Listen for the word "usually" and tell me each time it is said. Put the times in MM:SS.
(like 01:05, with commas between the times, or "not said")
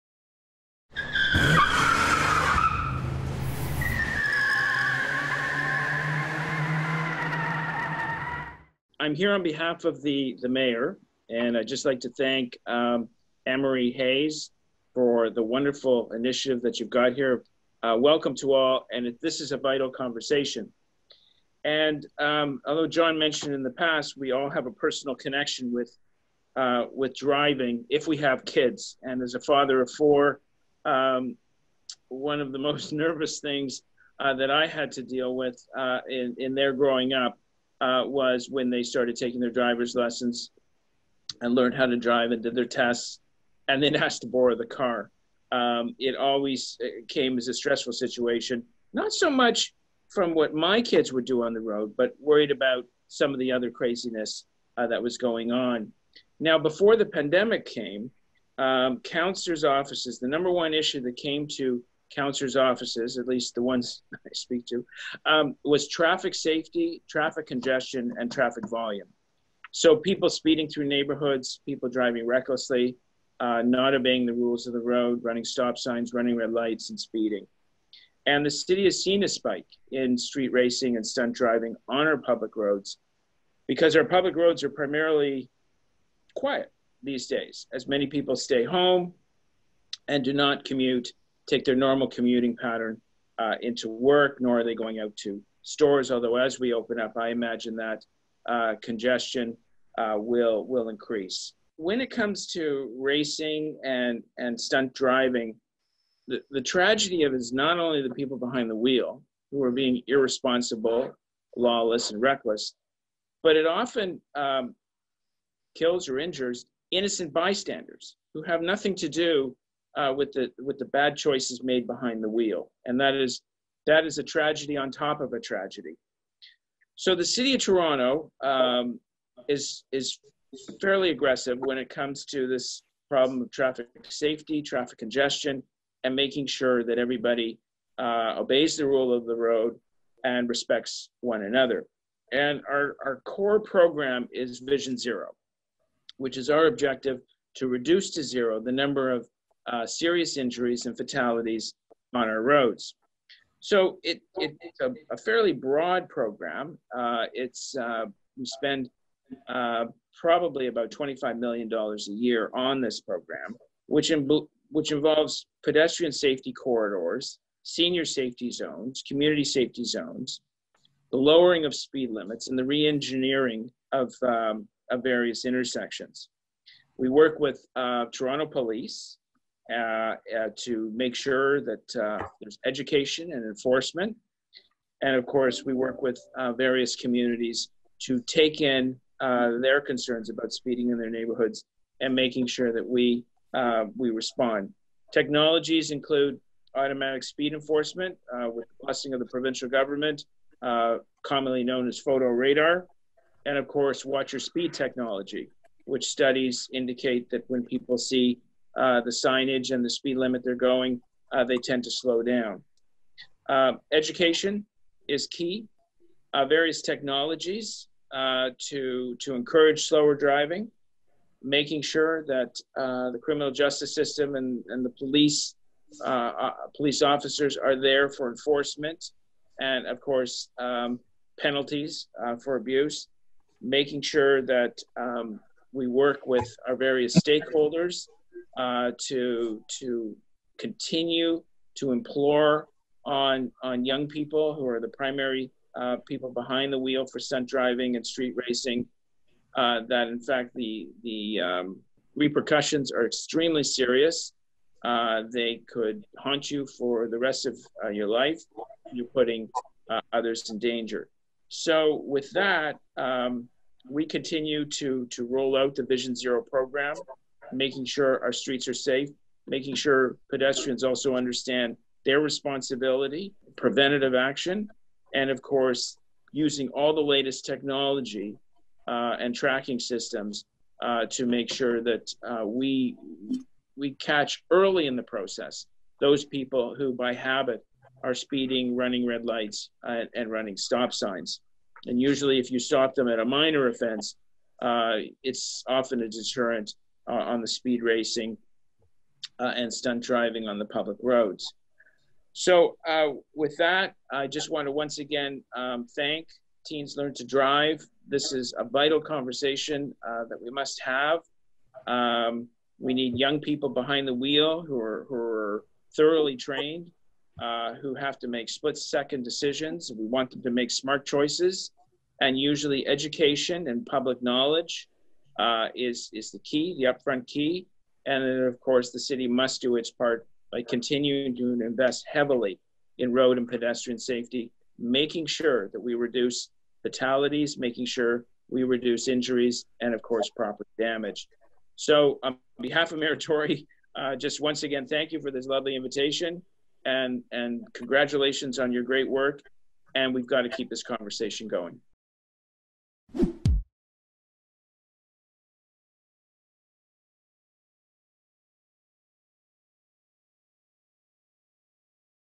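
04:52, 05:22.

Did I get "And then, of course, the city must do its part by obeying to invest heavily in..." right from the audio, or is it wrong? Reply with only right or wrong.
wrong.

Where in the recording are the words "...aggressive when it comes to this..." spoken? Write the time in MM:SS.
02:11.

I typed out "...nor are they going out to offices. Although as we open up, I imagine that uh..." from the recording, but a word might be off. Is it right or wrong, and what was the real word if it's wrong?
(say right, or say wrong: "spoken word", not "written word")
wrong: "stores", not "offices".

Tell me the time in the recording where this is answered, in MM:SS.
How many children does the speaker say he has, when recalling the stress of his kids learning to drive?
00:29.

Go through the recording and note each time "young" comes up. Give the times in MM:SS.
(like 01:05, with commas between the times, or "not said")
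04:03, 05:13.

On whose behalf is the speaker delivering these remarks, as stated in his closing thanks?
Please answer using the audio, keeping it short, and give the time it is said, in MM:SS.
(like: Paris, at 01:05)
Mayor Tory, at 05:42.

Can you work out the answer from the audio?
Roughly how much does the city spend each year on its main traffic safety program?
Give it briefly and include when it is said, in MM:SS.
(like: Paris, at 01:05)
$25 million, at 02:40.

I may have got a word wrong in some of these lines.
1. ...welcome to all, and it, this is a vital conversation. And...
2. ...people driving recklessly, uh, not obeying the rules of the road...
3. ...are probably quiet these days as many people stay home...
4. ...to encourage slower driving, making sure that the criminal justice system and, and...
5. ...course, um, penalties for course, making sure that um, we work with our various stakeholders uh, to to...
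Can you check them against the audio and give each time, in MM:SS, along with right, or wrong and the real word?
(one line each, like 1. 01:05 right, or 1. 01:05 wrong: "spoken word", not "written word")
1. 00:17 right
2. 01:11 right
3. 01:24 wrong: "primarily", not "probably"
4. 03:39 right
5. 03:49 wrong: "abuse", not "course".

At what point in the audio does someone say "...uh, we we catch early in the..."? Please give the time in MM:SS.
04:42.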